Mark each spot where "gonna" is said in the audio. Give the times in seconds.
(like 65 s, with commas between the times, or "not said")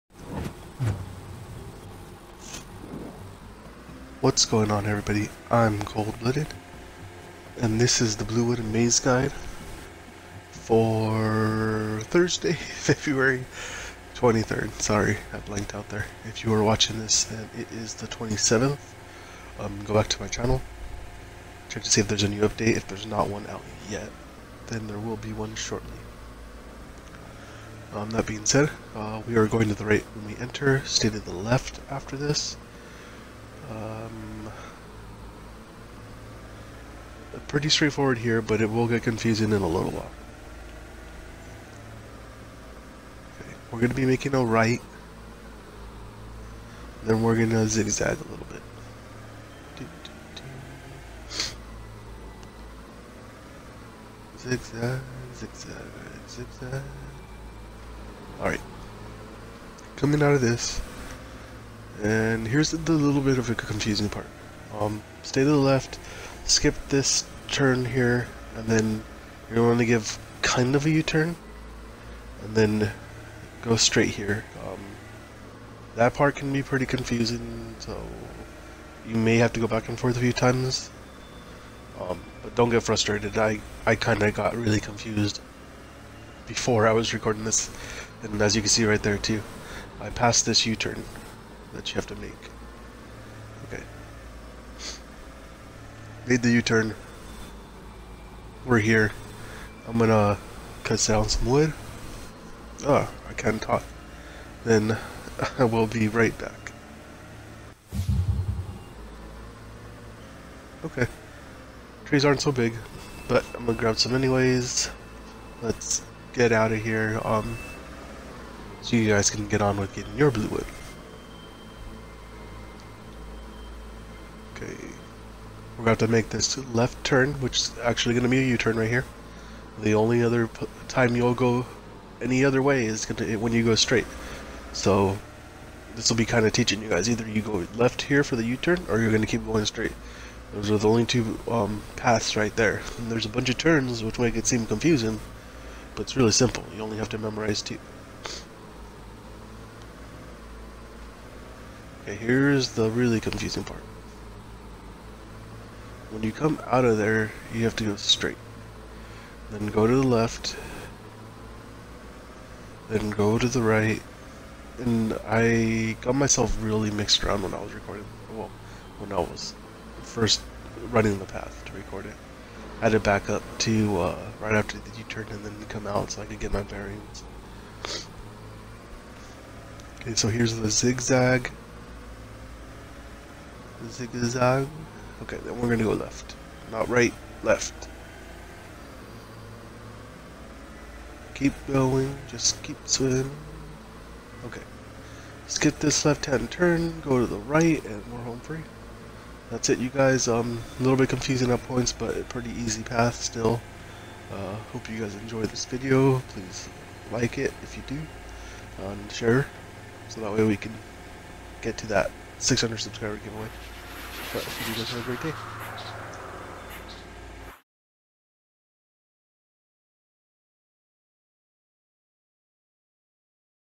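99 s, 113 s, 133 s, 185 s.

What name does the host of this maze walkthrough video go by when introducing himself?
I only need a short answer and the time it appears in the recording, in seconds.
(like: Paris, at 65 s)
Cold-Blooded, at 5 s.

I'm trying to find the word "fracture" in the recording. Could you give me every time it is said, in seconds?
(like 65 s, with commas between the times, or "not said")
not said.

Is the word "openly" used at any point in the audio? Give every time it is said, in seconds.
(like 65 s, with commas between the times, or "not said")
not said.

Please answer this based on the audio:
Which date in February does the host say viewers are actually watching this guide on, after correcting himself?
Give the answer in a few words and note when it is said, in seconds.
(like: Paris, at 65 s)
27th, at 17 s.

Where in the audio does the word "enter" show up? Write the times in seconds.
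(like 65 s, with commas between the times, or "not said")
30 s.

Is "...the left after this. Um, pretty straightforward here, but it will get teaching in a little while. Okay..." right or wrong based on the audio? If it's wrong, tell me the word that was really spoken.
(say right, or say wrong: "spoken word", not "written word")
wrong: "confusing", not "teaching".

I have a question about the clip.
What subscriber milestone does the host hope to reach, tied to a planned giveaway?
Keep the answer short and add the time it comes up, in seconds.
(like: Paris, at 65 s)
600, at 212 s.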